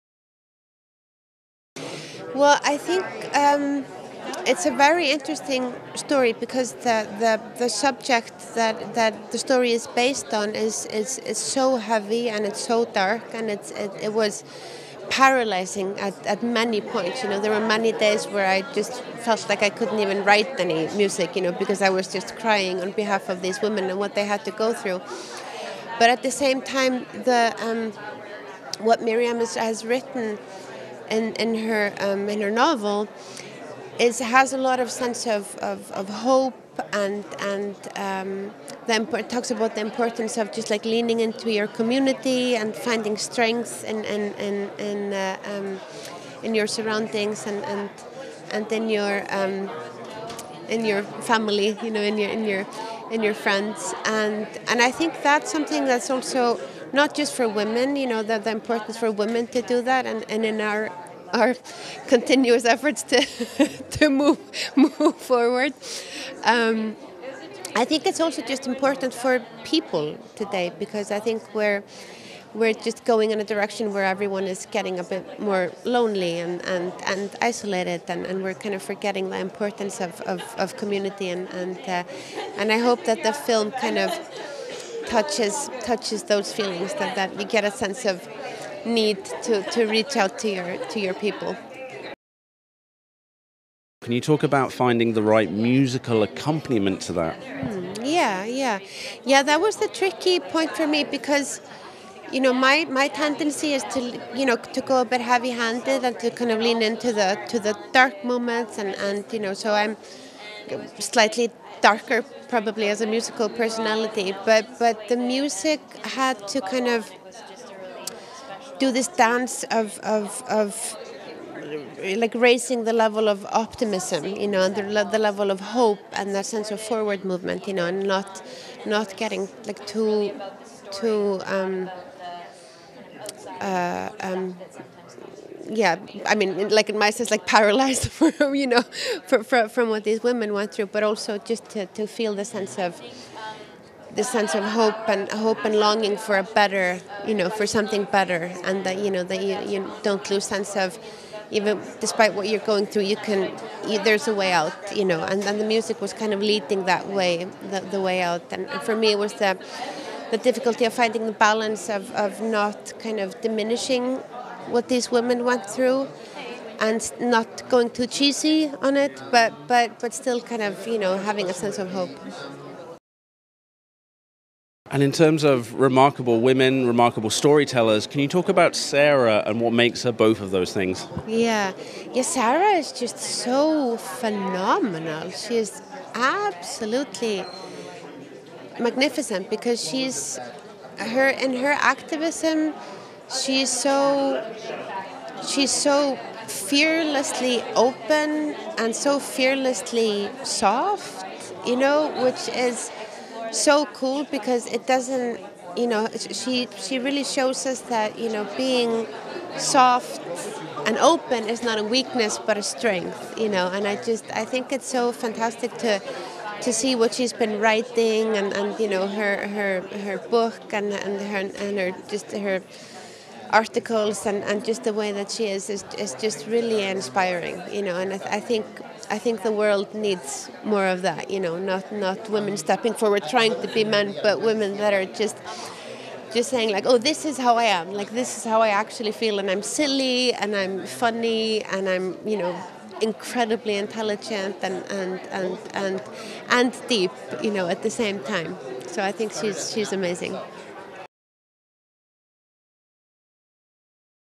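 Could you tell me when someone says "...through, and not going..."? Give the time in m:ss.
2:45.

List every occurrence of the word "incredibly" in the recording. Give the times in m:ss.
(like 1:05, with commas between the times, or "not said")
4:03.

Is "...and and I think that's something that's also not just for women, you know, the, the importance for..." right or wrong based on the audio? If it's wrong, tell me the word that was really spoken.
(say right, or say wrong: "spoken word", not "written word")
right.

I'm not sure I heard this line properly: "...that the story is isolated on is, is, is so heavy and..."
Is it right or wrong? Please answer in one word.
wrong.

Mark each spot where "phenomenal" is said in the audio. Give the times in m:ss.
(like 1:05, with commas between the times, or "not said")
3:03.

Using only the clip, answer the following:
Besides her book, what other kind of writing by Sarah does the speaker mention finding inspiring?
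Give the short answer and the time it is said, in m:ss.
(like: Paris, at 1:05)
articles, at 3:43.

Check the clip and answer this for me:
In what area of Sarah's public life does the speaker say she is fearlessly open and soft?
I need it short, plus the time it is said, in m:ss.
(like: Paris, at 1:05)
activism, at 3:11.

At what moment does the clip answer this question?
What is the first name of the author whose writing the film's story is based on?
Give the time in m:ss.
0:29.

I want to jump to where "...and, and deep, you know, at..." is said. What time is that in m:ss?
4:05.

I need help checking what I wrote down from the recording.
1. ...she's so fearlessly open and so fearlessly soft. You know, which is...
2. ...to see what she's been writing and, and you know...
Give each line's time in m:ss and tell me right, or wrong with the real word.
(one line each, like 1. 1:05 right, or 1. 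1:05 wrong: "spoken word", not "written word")
1. 3:15 right
2. 3:36 right.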